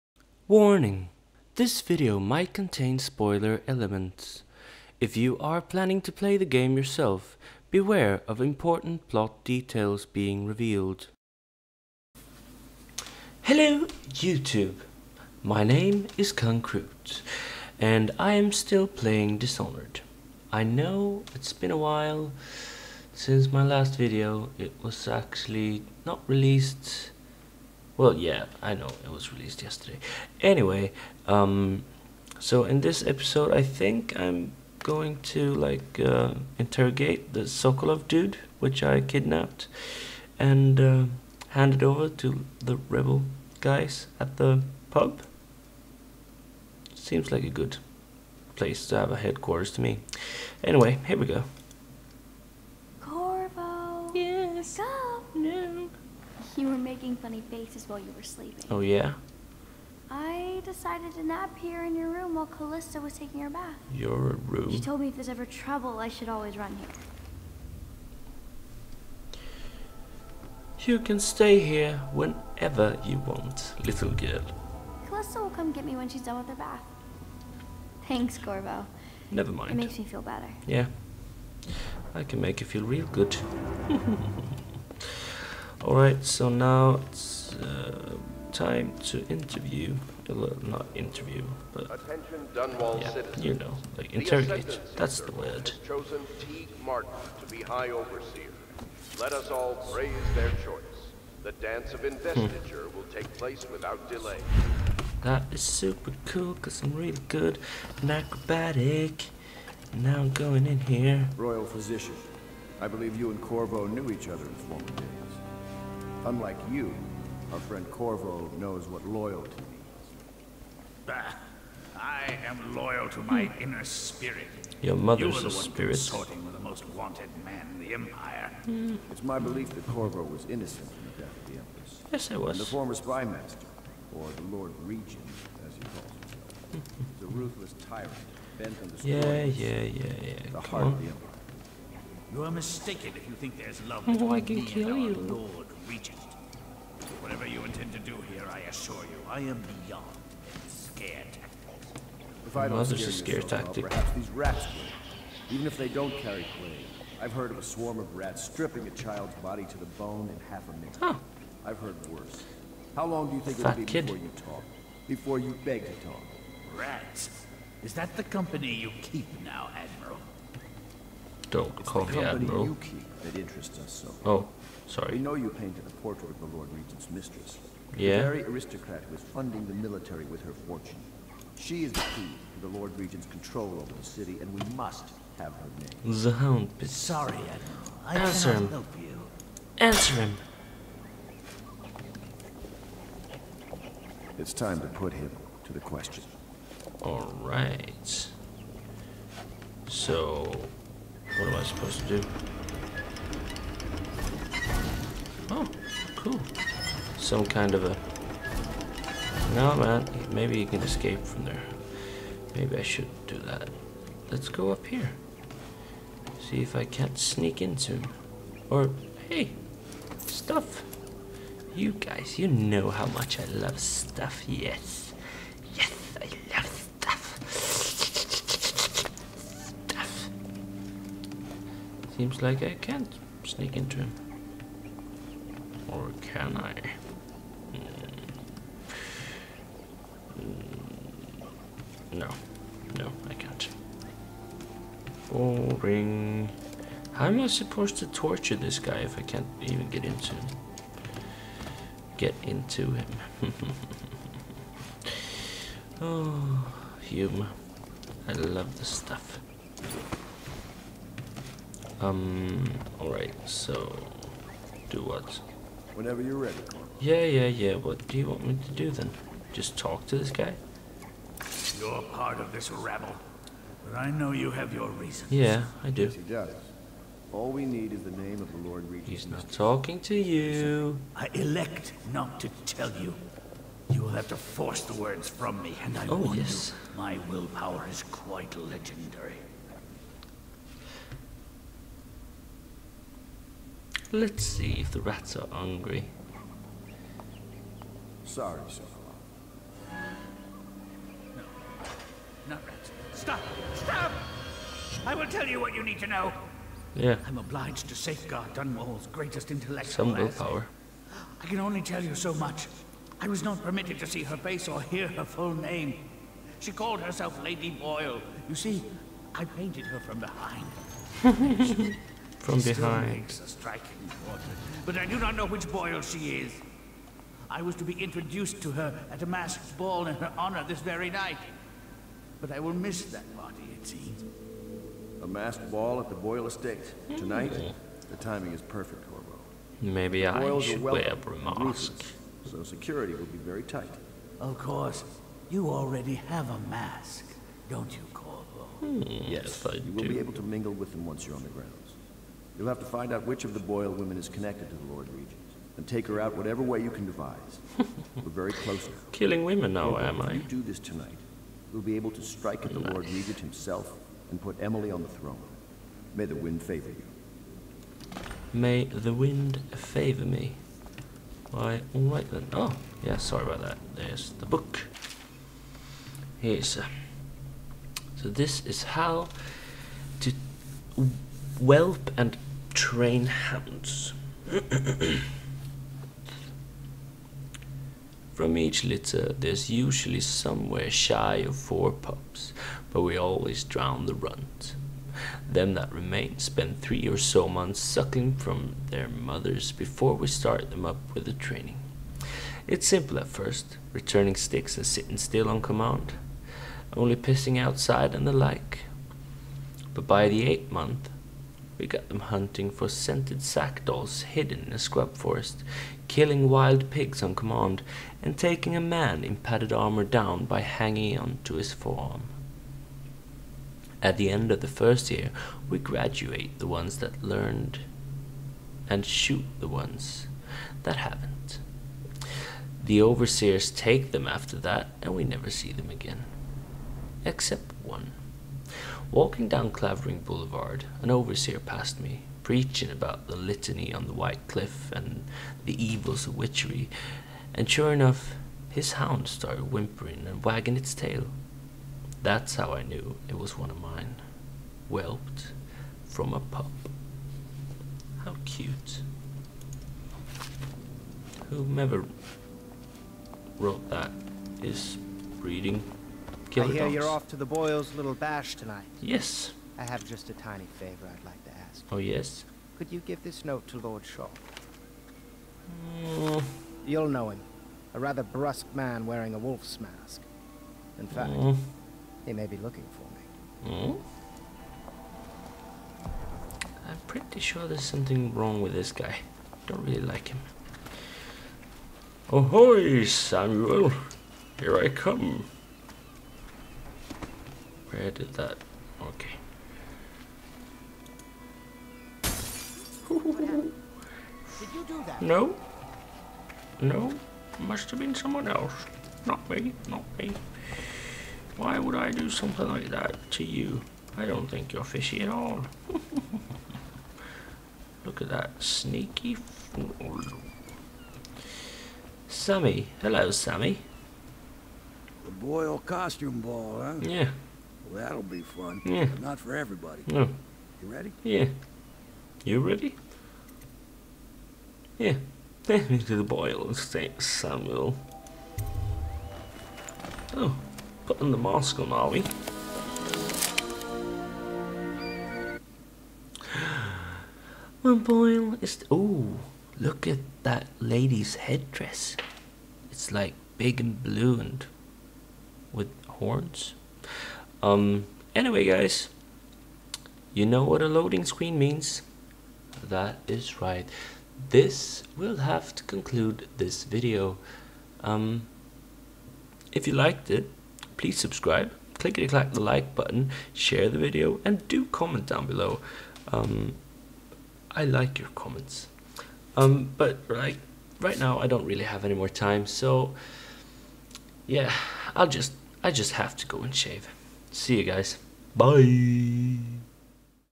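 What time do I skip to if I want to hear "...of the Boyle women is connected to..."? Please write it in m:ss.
5:53.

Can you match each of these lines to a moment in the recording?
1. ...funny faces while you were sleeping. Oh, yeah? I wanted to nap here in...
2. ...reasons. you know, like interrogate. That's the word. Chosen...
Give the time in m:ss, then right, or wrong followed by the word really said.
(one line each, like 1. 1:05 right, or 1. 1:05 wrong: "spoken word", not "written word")
1. 0:57 wrong: "decided", not "wanted"
2. 1:33 wrong: "citizens", not "reasons".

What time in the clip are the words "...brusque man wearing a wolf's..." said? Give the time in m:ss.
7:58.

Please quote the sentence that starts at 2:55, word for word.
We know you painted a portrait of the Lord Regent's mistress.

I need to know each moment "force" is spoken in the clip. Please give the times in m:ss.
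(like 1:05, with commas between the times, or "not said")
4:44.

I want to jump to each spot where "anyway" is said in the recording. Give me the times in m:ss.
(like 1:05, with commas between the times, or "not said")
0:30, 0:50, 9:18.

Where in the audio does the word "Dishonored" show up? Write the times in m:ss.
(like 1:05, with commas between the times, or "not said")
0:19.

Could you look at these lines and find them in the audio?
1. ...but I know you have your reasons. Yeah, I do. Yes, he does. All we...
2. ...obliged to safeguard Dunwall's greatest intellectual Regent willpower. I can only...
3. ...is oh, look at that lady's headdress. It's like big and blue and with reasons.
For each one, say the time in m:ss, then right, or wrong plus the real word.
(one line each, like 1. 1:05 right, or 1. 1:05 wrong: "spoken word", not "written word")
1. 4:33 right
2. 5:07 wrong: "Some", not "Regent"
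3. 9:08 wrong: "horns", not "reasons".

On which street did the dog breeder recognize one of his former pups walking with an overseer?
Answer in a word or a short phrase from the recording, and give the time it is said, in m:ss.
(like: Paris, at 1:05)
Clavering Boulevard, at 7:19.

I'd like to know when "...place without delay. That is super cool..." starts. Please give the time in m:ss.
1:43.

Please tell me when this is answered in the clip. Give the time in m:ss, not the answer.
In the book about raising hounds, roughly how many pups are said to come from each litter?
6:31.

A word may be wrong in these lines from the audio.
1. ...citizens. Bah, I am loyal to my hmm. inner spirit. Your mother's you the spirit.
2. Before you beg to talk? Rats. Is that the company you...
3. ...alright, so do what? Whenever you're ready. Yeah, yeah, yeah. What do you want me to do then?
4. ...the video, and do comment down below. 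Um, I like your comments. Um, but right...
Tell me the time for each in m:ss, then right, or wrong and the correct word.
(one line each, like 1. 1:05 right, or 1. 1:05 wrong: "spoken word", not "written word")
1. 1:59 wrong: "means", not "citizens"
2. 2:45 right
3. 4:22 right
4. 9:33 right.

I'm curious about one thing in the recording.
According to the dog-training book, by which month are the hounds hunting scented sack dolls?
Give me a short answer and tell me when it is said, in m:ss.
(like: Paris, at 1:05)
Eighth month, at 6:50.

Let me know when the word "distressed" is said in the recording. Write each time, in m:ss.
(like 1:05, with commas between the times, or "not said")
not said.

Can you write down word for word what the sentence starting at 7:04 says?
At the end of the first year, we graduate the ones that learned and shoot the ones that haven't.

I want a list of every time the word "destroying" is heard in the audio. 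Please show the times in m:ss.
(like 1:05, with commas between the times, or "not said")
2:18.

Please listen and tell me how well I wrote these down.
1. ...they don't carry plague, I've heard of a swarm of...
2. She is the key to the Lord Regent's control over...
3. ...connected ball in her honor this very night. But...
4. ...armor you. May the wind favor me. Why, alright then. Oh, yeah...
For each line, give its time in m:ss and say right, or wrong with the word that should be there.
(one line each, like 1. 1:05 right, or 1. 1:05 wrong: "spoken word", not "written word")
1. 2:35 right
2. 3:01 right
3. 5:29 wrong: "masked", not "connected"
4. 6:06 wrong: "favor", not "armor".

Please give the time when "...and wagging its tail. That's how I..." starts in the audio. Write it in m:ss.
7:30.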